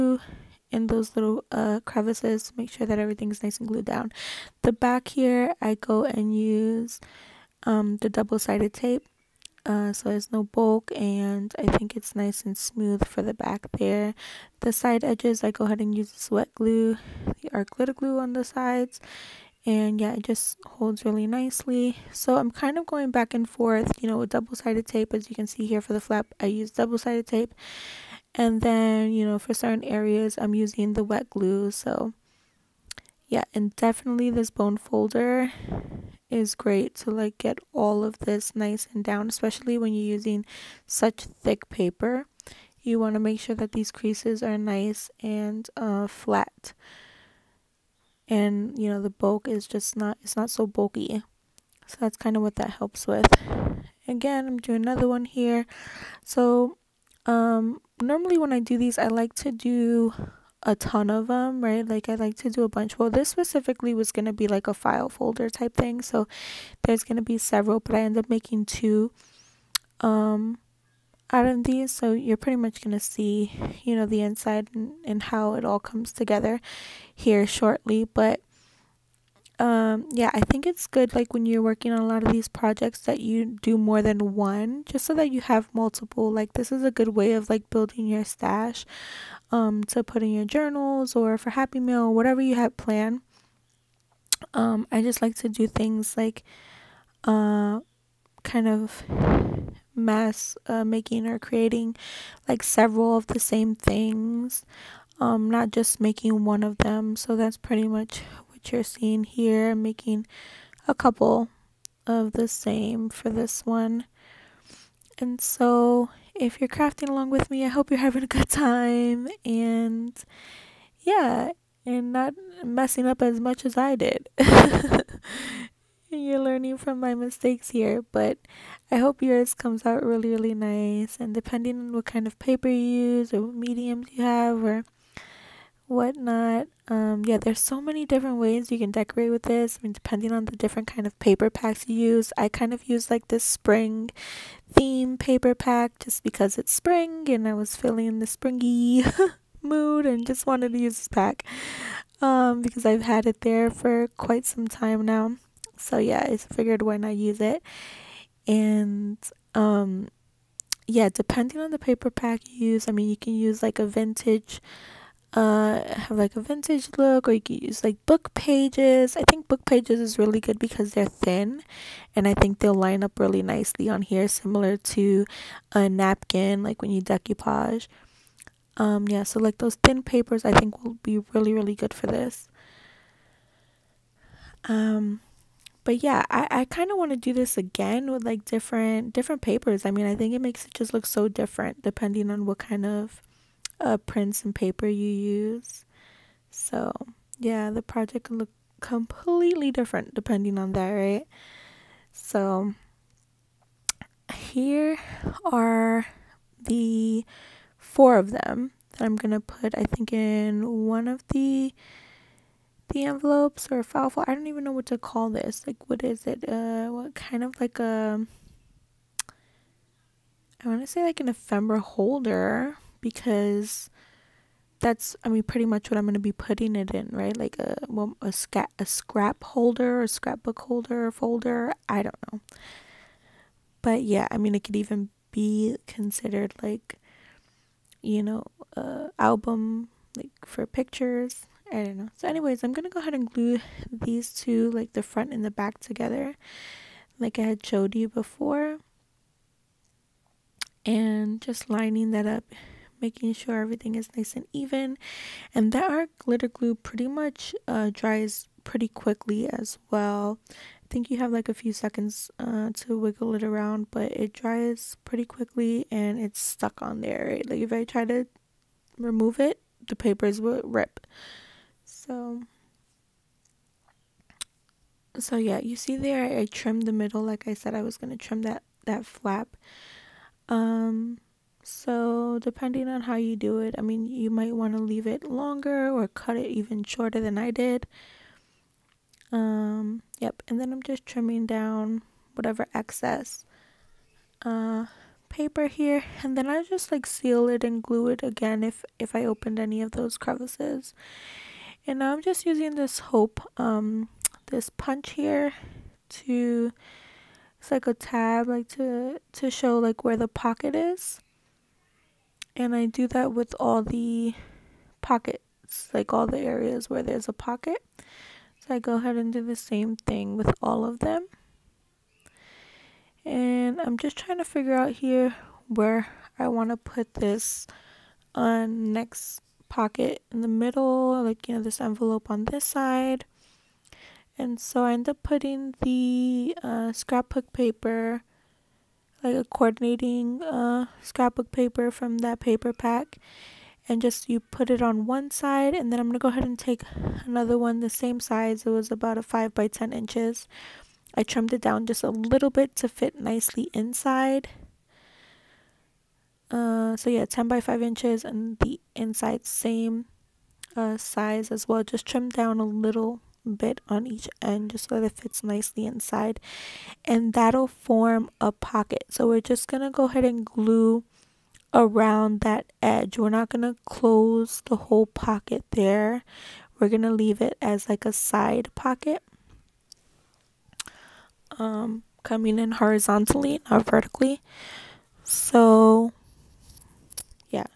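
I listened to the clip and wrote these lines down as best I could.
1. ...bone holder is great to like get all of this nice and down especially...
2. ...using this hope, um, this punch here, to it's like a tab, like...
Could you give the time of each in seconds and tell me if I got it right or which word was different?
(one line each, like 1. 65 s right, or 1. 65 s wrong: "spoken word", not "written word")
1. 34 s wrong: "folder", not "holder"
2. 302 s right.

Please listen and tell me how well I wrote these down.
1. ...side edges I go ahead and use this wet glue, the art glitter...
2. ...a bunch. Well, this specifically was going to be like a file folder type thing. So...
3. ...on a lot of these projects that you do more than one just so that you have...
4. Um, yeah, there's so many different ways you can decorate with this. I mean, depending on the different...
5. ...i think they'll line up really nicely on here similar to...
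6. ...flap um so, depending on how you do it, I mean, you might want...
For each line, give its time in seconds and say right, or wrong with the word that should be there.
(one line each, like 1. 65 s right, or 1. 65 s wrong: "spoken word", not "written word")
1. 14 s right
2. 62 s right
3. 81 s right
4. 136 s right
5. 172 s right
6. 279 s right.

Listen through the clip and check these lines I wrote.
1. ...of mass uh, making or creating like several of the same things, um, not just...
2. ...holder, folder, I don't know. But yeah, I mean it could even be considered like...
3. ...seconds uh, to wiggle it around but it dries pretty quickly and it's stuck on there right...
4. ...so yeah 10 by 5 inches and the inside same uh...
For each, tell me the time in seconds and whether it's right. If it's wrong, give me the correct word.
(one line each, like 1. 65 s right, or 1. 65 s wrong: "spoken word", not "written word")
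1. 98 s right
2. 230 s right
3. 261 s right
4. 356 s right.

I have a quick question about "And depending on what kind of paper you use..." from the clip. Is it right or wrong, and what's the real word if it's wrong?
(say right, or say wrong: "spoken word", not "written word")
right.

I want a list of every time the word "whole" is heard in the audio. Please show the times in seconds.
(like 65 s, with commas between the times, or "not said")
374 s.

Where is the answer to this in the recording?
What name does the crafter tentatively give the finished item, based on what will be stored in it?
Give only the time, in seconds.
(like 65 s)
221 s.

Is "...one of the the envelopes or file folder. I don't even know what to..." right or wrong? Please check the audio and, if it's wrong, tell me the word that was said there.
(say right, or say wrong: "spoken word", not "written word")
right.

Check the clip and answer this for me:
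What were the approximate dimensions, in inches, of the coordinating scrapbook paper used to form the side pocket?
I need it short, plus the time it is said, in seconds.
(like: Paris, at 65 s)
5 by 10 inches, at 349 s.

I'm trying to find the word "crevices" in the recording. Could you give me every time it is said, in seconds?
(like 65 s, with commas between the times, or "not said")
1 s, 300 s.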